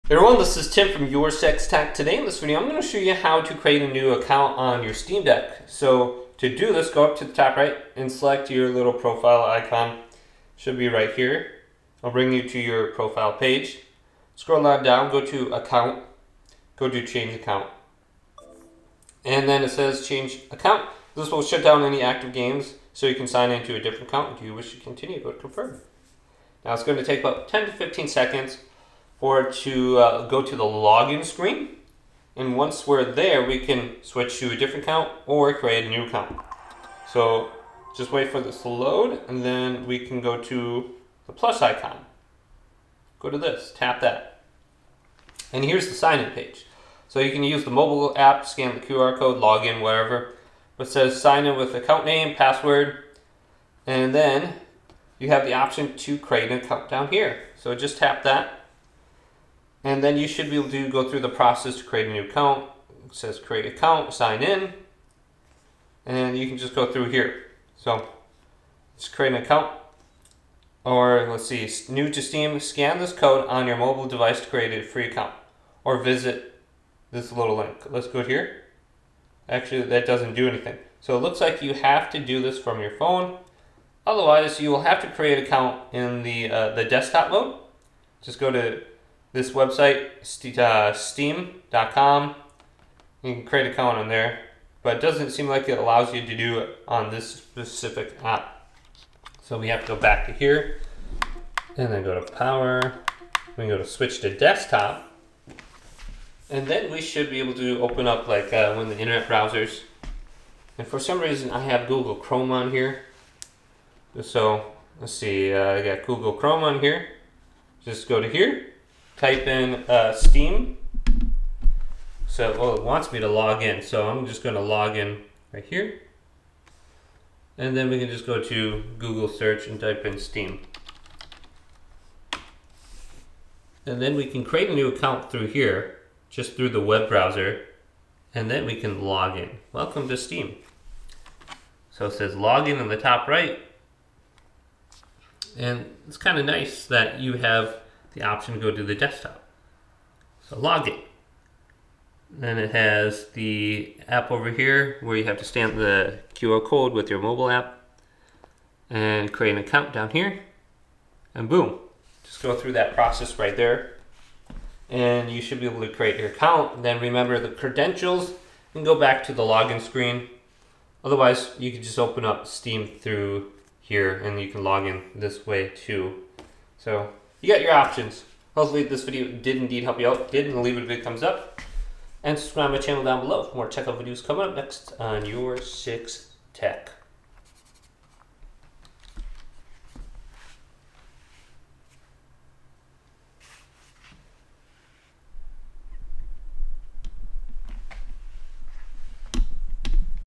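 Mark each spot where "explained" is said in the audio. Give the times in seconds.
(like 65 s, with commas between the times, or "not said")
not said.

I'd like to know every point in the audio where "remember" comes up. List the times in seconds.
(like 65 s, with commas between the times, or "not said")
167 s.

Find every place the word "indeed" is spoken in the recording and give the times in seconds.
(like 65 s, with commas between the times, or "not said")
179 s.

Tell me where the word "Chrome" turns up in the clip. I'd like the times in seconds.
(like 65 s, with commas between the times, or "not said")
112 s, 116 s.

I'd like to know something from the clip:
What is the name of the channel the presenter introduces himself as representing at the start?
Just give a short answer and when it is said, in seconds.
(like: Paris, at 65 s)
Your Six Tech, at 1 s.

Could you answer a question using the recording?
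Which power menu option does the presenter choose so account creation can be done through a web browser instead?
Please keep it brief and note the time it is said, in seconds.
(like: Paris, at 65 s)
Switch to desktop, at 103 s.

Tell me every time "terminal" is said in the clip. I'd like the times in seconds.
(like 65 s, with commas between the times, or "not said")
not said.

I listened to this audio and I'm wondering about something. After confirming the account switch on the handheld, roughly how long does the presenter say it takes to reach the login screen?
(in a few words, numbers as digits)
10 to 15 seconds.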